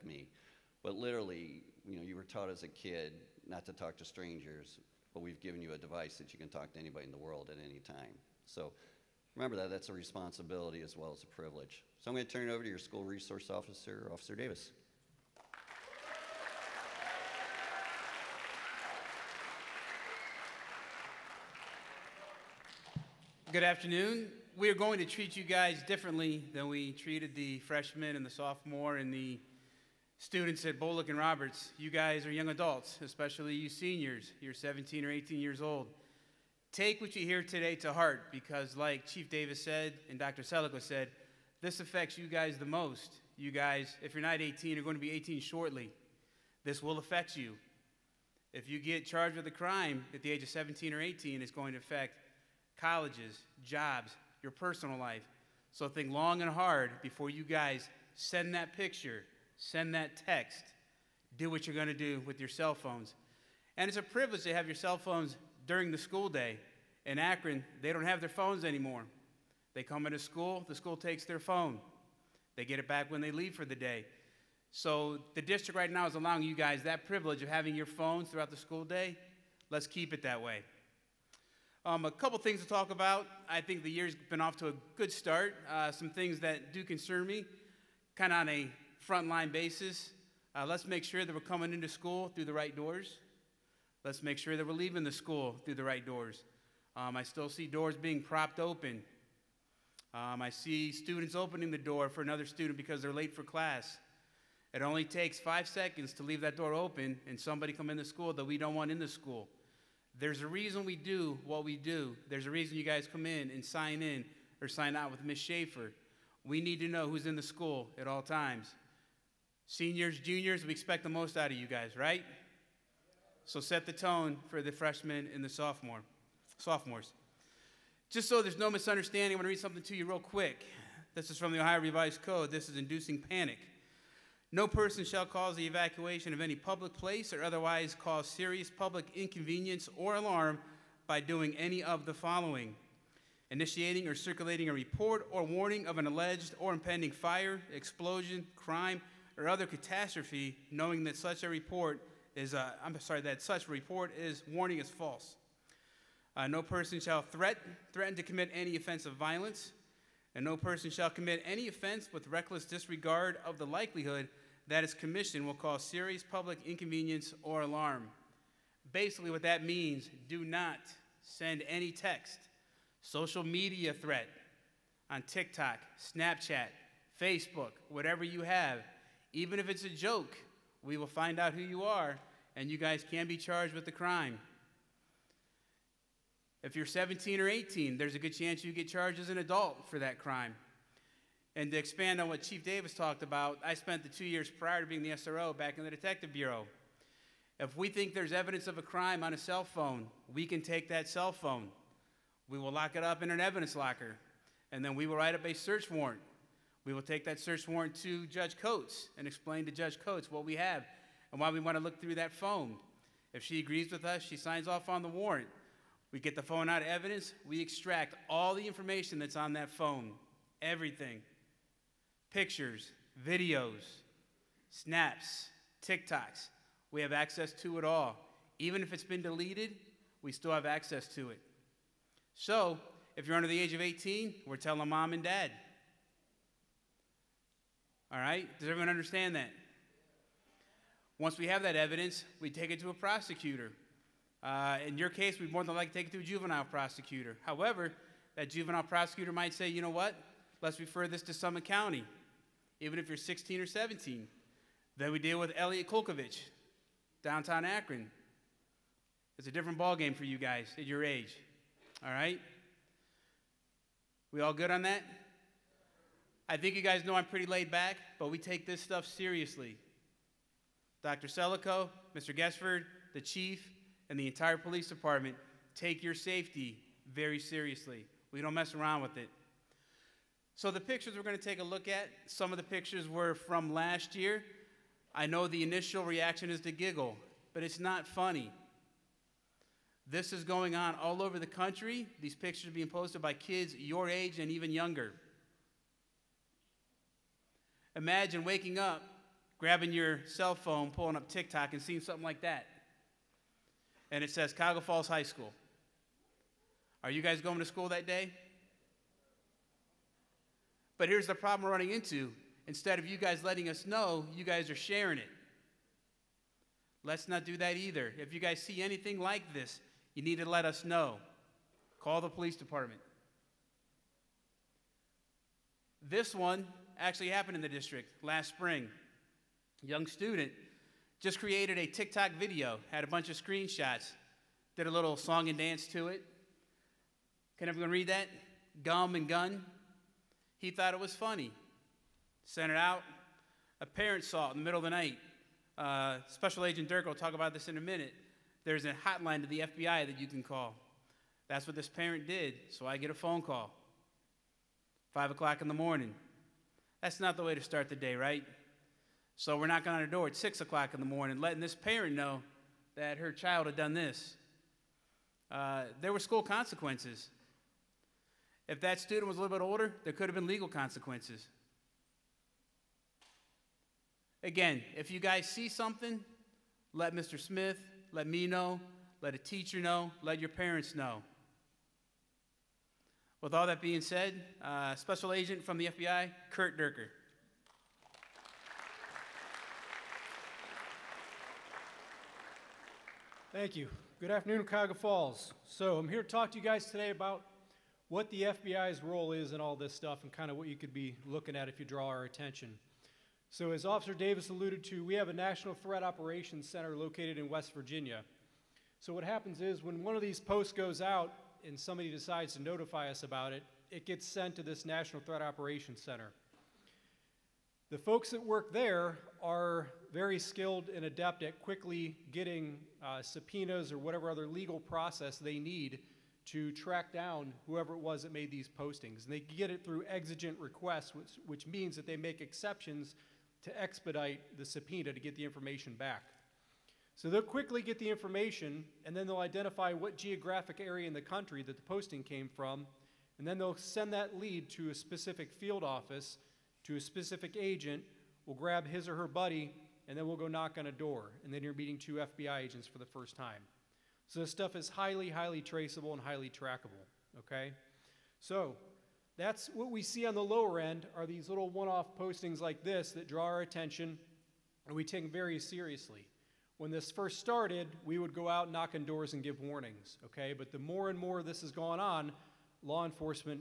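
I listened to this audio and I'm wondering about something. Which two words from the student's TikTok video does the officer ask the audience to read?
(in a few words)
Gum and gun.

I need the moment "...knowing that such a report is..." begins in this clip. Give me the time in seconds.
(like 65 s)
150 s.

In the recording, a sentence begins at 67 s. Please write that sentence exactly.
In Akron, they don't have their phones anymore.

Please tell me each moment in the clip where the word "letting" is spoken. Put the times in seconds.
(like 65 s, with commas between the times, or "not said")
313 s, 361 s.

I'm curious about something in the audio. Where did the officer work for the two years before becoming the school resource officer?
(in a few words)
Detective Bureau.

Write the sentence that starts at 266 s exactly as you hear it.
I think you guys know I'm pretty laid back, but we take this stuff seriously.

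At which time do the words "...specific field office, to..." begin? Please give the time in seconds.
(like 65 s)
444 s.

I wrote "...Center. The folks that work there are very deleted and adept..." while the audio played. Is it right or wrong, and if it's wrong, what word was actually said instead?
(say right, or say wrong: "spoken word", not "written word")
wrong: "skilled", not "deleted".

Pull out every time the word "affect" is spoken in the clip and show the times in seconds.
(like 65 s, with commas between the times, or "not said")
41 s, 46 s, 51 s.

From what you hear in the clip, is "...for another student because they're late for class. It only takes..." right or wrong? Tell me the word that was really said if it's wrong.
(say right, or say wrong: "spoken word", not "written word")
right.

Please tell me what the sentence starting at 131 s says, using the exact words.
This is from the Ohio Revised Code.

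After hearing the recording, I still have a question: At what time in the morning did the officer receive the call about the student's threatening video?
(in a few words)
5 o'clock.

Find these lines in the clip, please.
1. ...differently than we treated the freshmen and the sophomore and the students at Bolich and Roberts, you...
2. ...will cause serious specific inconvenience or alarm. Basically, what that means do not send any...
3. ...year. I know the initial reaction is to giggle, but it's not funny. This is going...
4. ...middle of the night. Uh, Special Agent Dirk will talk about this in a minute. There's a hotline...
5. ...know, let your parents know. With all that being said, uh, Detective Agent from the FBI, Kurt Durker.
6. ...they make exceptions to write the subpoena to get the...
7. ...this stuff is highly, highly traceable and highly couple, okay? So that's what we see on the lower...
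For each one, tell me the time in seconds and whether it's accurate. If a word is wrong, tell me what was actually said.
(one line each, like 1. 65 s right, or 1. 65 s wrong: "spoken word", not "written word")
1. 25 s right
2. 165 s wrong: "public", not "specific"
3. 284 s right
4. 344 s right
5. 379 s wrong: "Special", not "Detective"
6. 432 s wrong: "expedite", not "write"
7. 454 s wrong: "trackable", not "couple".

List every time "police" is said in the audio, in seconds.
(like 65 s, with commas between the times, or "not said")
274 s, 322 s.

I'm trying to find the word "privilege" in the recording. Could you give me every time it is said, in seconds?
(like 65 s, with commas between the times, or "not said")
11 s, 64 s, 77 s.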